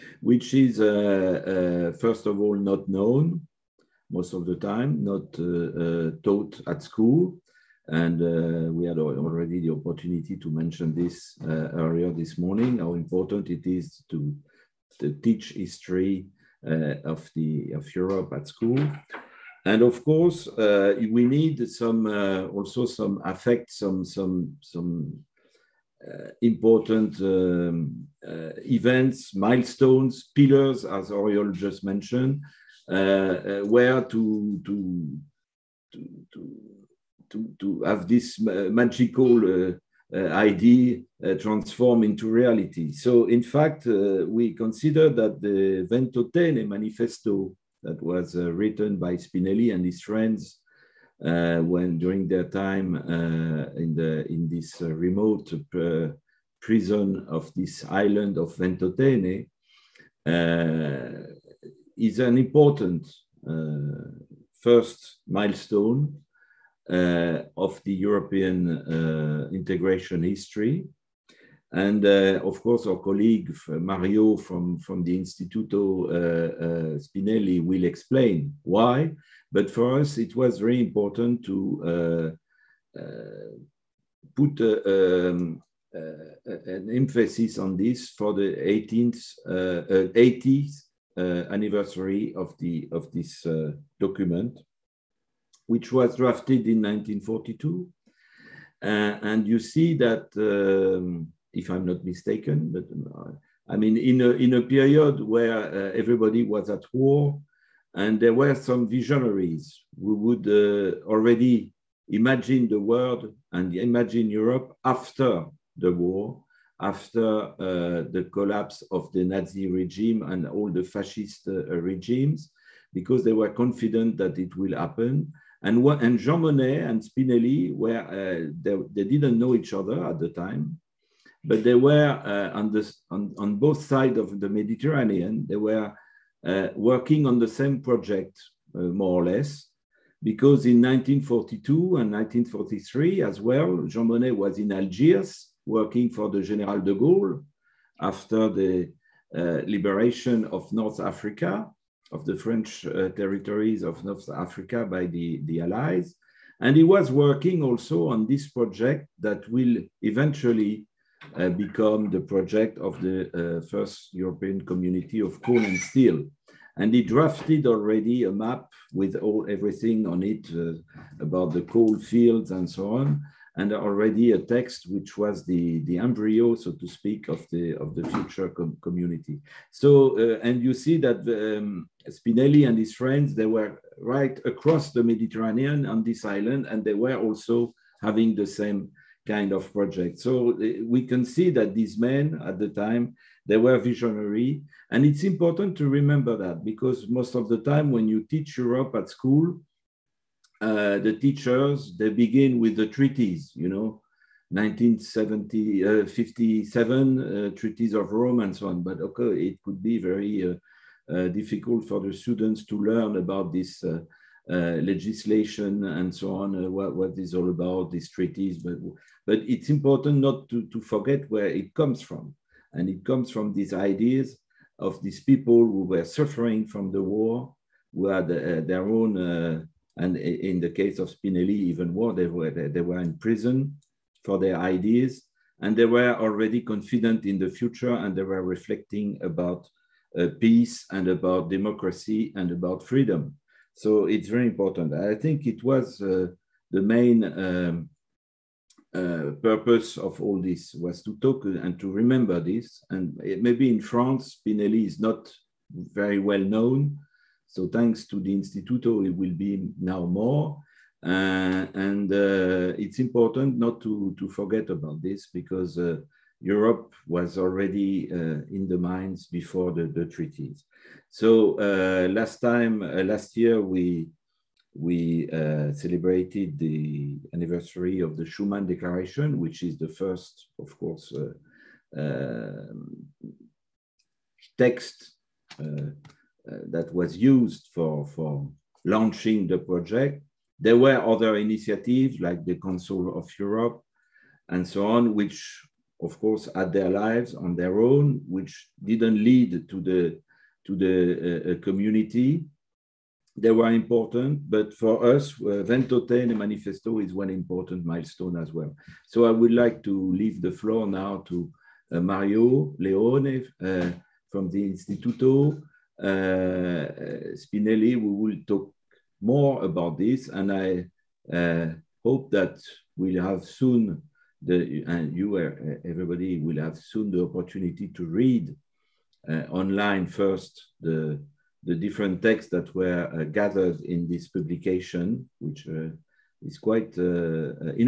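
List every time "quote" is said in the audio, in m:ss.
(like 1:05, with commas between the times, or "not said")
not said.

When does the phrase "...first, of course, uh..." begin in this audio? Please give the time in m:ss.
4:39.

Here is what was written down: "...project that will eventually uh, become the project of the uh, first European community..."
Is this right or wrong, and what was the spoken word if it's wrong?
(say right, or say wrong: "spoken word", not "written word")
right.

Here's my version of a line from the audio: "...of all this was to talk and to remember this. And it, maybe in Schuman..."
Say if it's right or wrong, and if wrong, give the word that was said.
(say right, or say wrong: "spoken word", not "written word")
wrong: "France", not "Schuman".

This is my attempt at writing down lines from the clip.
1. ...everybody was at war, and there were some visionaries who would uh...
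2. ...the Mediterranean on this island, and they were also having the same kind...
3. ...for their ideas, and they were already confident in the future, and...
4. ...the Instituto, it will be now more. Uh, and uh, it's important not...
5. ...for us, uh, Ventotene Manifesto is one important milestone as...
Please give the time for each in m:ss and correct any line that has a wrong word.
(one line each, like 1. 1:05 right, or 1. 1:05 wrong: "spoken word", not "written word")
1. 1:45 right
2. 3:04 right
3. 3:54 right
4. 4:18 right
5. 5:04 right.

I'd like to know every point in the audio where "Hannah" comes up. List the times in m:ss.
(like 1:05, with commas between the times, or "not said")
not said.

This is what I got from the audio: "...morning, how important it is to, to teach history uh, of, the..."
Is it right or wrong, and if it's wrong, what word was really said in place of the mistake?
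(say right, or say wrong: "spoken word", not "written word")
right.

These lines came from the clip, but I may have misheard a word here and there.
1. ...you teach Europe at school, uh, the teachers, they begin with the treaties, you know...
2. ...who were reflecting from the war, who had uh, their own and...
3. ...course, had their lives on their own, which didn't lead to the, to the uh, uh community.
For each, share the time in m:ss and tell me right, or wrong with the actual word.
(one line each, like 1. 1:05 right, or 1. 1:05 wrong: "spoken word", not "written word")
1. 3:18 right
2. 3:45 wrong: "suffering", not "reflecting"
3. 4:56 right.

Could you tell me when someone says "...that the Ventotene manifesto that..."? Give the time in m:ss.
0:45.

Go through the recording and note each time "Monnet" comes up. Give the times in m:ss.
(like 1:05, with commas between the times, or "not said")
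2:06, 2:24.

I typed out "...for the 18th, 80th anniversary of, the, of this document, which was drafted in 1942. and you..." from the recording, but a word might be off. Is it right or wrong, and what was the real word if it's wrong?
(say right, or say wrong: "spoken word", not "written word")
right.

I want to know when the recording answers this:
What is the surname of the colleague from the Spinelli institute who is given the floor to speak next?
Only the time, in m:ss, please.
5:12.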